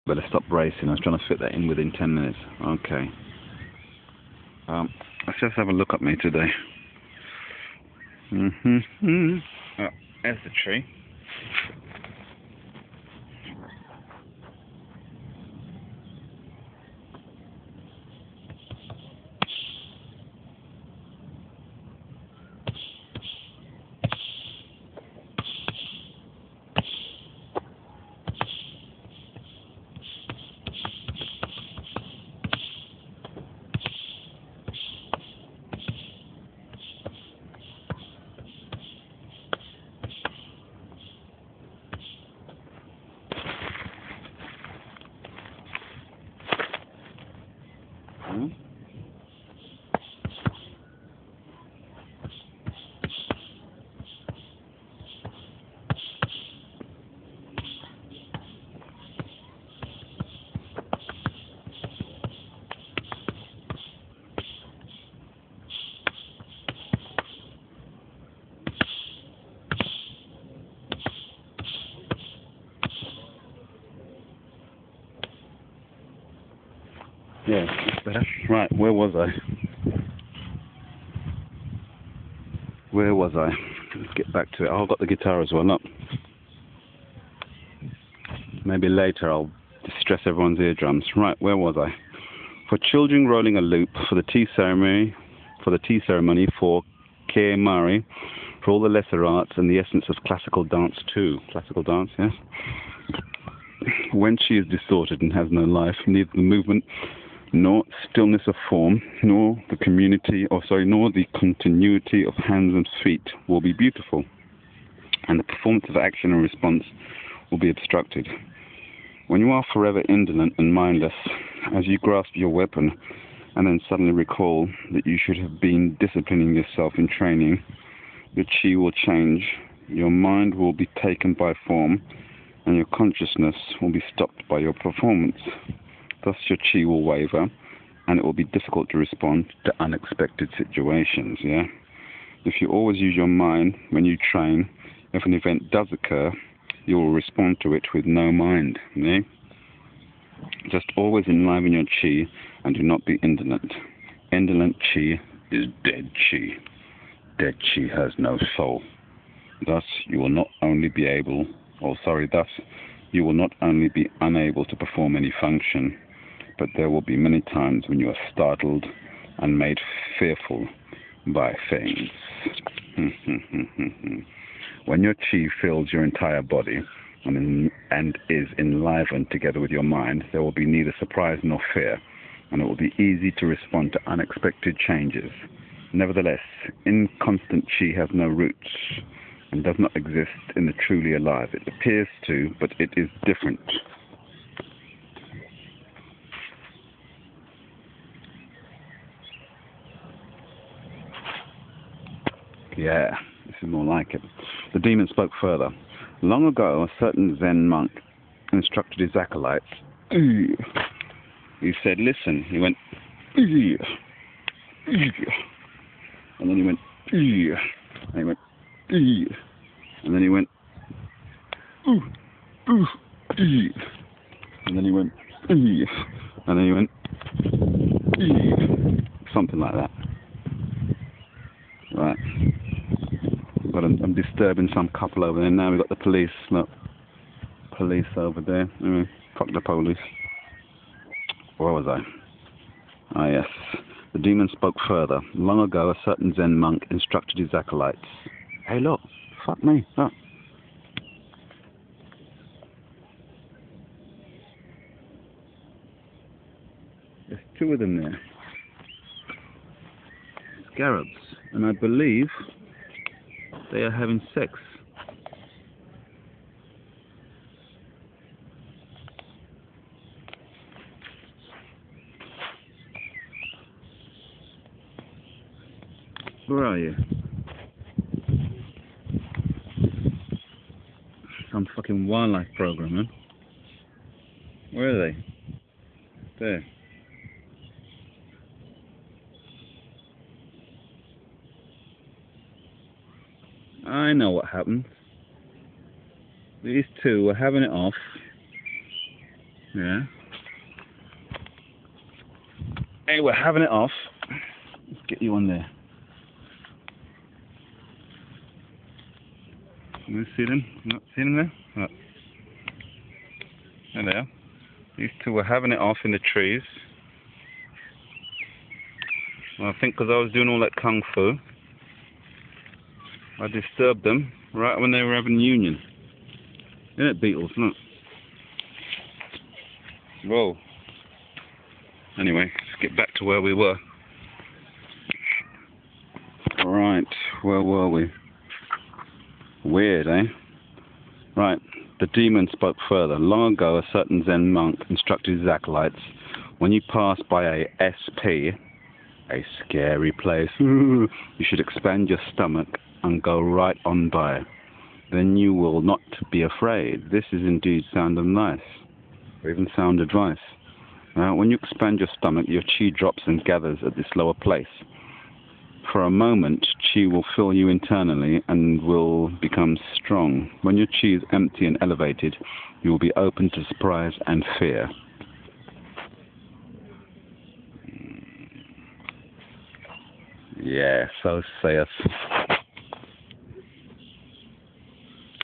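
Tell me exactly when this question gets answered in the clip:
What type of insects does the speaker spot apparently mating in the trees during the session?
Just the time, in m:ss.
4:20.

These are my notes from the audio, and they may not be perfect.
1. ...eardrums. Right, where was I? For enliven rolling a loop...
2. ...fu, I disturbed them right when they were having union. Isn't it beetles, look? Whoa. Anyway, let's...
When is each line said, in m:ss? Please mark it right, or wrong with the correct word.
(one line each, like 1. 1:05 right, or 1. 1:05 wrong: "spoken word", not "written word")
1. 1:30 wrong: "children", not "enliven"
2. 5:21 right.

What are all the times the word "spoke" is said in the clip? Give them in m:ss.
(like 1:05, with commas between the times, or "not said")
3:25, 4:04, 5:42.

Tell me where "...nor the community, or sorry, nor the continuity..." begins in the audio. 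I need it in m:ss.
1:49.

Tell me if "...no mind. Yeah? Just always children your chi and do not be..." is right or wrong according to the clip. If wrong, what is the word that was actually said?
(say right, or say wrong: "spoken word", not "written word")
wrong: "enliven", not "children".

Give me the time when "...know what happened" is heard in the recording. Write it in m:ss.
4:54.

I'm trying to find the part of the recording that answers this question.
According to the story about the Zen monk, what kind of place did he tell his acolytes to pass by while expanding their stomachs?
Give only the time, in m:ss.
5:49.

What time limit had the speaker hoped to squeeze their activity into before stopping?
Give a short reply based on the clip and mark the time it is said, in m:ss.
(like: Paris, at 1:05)
10 minutes, at 0:01.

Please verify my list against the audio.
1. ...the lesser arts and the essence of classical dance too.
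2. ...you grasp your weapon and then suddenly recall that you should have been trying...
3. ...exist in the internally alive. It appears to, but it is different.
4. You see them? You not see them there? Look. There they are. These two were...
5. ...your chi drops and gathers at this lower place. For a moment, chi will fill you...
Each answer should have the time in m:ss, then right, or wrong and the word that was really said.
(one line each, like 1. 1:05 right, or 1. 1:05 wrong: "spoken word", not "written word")
1. 1:38 right
2. 2:01 wrong: "disciplining", not "trying"
3. 3:09 wrong: "truly", not "internally"
4. 5:10 right
5. 6:02 right.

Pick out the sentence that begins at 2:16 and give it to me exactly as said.
Thus, your chi will waver and it will be difficult to respond to unexpected situations.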